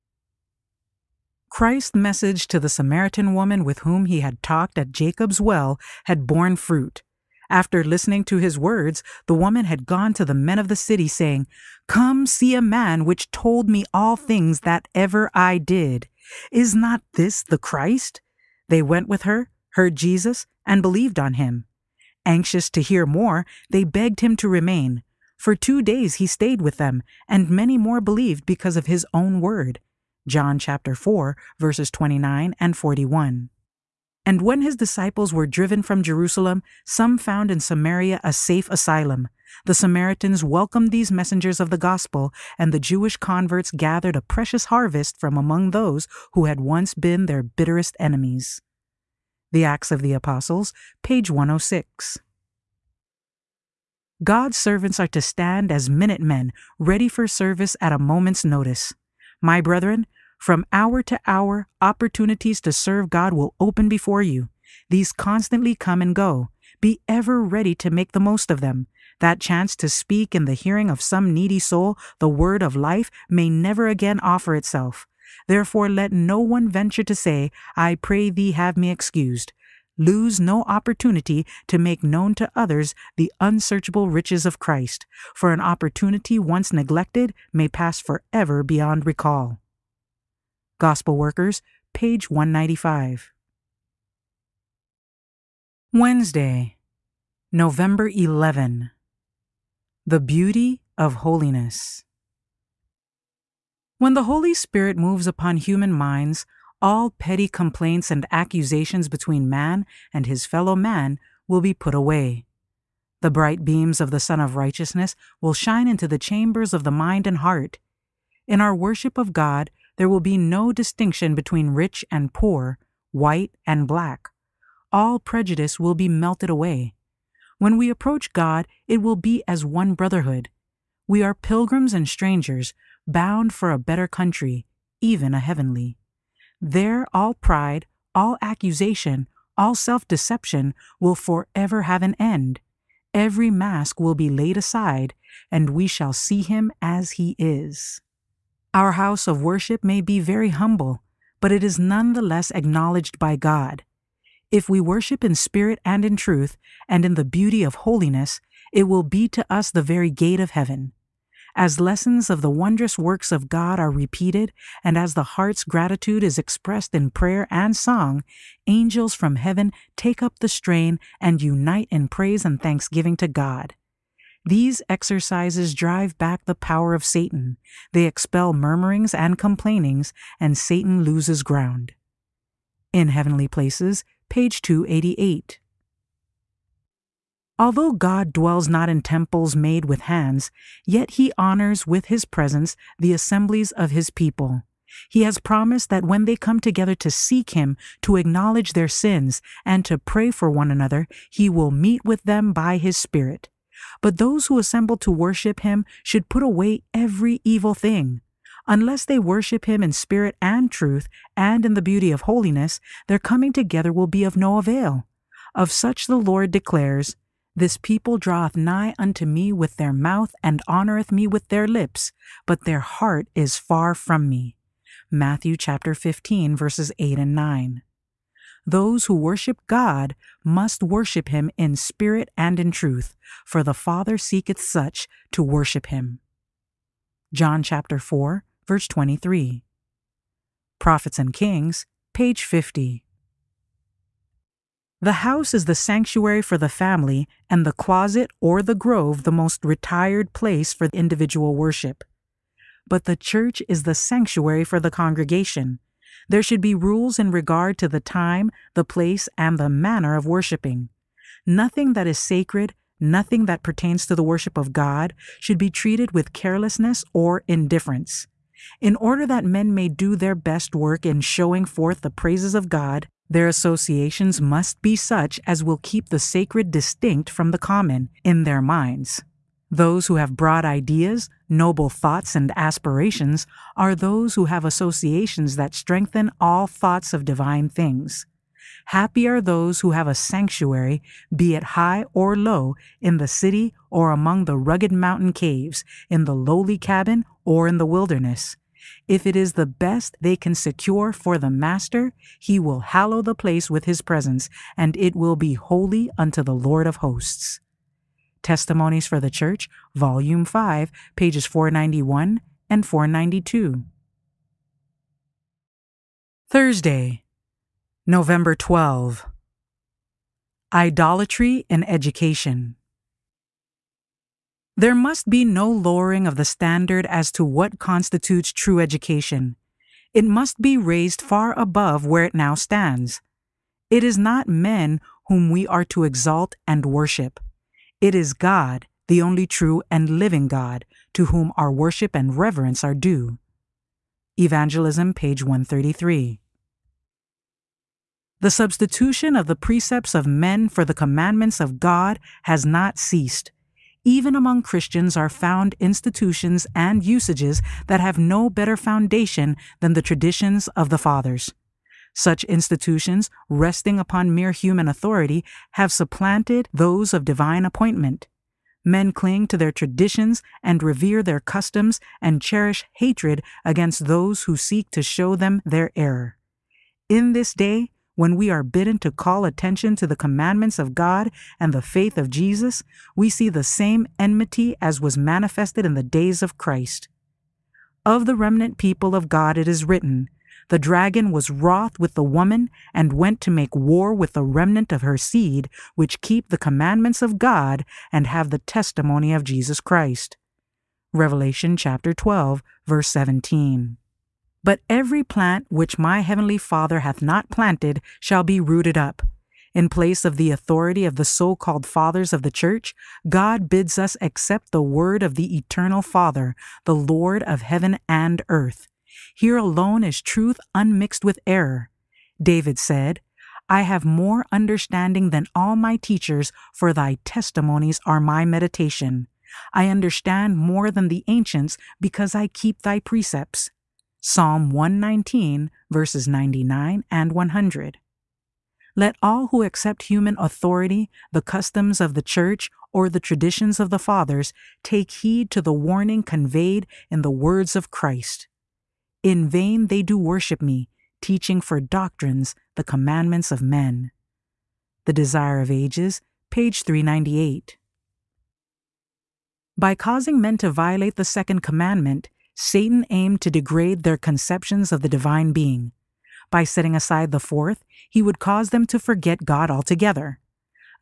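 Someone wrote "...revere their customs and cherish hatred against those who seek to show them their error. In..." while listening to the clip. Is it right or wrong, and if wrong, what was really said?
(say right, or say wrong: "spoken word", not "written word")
right.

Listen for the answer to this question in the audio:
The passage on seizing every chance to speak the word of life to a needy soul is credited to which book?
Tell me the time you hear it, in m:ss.
1:30.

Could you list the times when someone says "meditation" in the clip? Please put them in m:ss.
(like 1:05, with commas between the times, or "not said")
7:08.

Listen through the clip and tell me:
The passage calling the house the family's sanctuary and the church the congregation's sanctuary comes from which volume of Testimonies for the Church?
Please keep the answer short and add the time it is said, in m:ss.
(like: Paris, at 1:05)
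Volume 5, at 5:09.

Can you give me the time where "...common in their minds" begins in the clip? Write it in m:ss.
4:37.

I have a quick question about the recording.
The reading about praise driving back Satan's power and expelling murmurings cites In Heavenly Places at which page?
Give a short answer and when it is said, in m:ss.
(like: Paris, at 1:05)
288, at 3:04.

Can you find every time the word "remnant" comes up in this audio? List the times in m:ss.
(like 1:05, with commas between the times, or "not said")
6:28, 6:34.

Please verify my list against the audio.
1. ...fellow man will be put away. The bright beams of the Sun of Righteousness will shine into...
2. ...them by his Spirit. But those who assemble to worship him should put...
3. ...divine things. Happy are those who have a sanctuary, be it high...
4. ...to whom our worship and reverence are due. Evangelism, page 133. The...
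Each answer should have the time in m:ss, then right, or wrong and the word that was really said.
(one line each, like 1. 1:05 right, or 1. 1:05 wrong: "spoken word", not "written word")
1. 1:50 right
2. 3:22 right
3. 4:47 right
4. 5:41 right.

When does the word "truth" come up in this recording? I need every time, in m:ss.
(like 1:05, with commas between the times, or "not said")
2:36, 3:30, 3:52, 7:00.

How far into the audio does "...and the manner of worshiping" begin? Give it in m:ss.
4:19.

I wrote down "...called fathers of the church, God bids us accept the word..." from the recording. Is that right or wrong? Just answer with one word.
right.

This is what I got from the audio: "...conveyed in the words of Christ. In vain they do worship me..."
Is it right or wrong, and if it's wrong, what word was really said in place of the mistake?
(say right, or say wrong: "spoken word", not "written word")
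right.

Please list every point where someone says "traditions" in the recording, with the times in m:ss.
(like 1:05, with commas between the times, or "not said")
6:00, 6:09, 7:23.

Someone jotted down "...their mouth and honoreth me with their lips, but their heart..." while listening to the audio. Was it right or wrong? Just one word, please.
right.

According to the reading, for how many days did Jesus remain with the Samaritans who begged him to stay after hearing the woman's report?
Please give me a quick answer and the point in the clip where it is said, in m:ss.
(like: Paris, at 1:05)
2, at 0:25.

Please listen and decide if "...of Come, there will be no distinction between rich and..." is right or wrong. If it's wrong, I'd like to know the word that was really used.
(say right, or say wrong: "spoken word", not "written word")
wrong: "God", not "Come".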